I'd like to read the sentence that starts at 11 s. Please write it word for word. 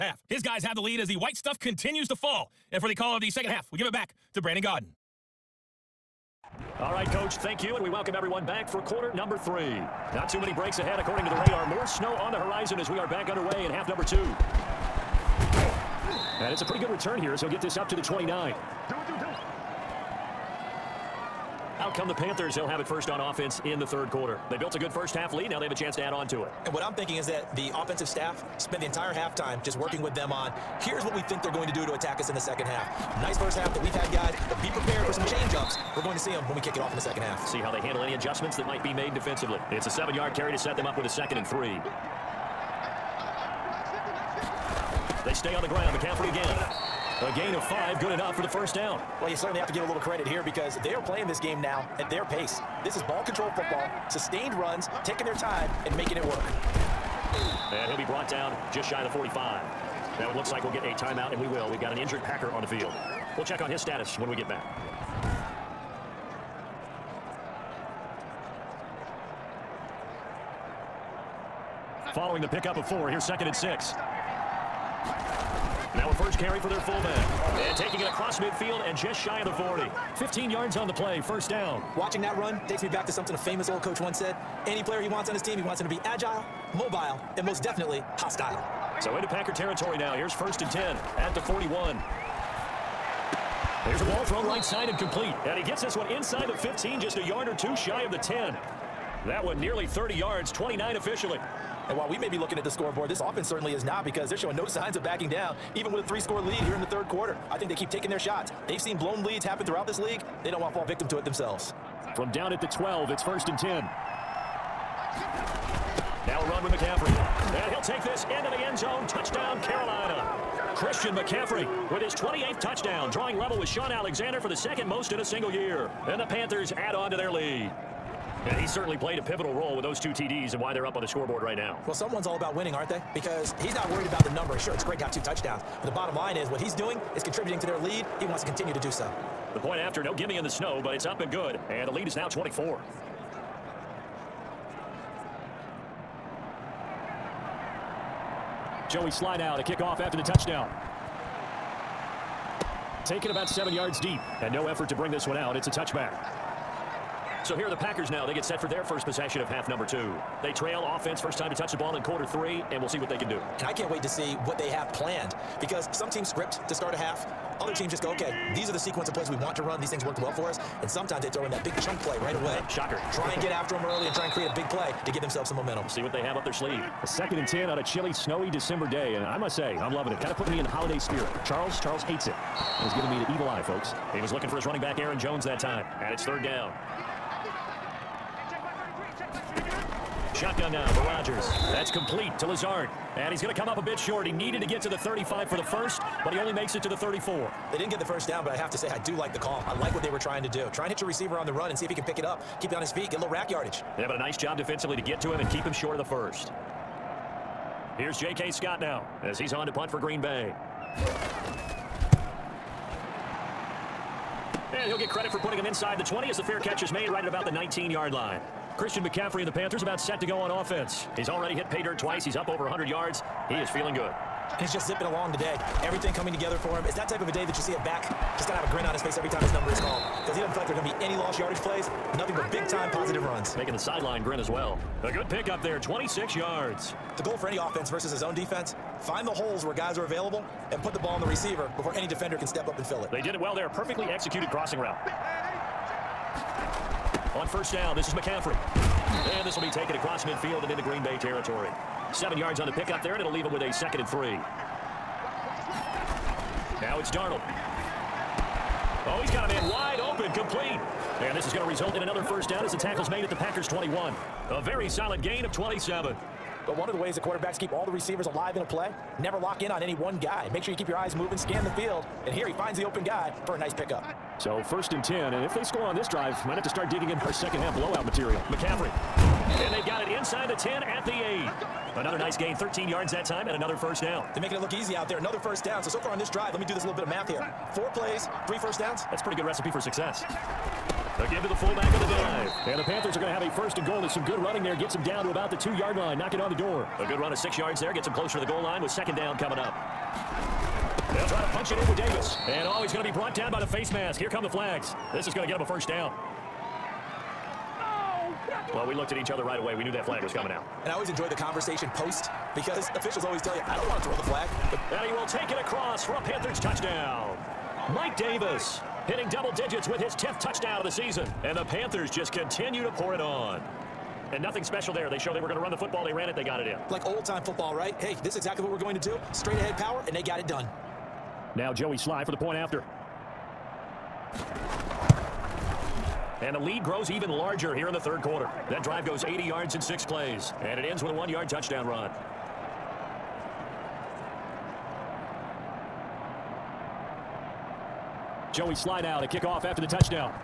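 More snow on the horizon as we are back underway in half number two.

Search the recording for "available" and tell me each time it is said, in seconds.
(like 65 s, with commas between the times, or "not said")
240 s.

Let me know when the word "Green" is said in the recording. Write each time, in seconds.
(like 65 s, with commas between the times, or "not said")
209 s, 250 s.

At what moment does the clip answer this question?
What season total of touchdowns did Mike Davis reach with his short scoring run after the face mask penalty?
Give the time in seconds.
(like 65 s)
320 s.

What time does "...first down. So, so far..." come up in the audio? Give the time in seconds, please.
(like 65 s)
285 s.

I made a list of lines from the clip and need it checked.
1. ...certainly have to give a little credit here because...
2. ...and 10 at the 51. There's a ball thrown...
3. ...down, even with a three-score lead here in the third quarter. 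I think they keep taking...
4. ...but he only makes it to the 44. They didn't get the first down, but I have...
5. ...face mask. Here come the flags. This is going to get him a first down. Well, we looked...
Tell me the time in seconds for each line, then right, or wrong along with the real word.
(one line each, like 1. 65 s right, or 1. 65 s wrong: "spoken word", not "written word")
1. 49 s right
2. 90 s wrong: "41", not "51"
3. 105 s right
4. 196 s wrong: "34", not "44"
5. 303 s right.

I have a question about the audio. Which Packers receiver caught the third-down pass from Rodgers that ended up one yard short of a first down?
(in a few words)
Lazard.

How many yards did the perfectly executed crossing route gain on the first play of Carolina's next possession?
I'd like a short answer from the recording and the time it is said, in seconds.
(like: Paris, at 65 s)
26, at 235 s.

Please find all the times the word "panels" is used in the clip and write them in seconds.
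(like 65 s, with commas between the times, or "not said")
not said.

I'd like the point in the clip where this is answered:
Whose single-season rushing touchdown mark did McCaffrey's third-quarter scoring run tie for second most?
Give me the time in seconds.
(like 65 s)
123 s.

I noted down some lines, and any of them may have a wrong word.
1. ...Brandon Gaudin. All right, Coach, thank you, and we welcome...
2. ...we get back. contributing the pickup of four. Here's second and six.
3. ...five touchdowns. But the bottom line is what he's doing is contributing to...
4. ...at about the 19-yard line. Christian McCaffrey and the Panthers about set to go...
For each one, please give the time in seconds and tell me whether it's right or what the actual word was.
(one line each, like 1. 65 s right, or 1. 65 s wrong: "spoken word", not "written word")
1. 4 s right
2. 64 s wrong: "following", not "contributing"
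3. 135 s wrong: "two", not "five"
4. 217 s right.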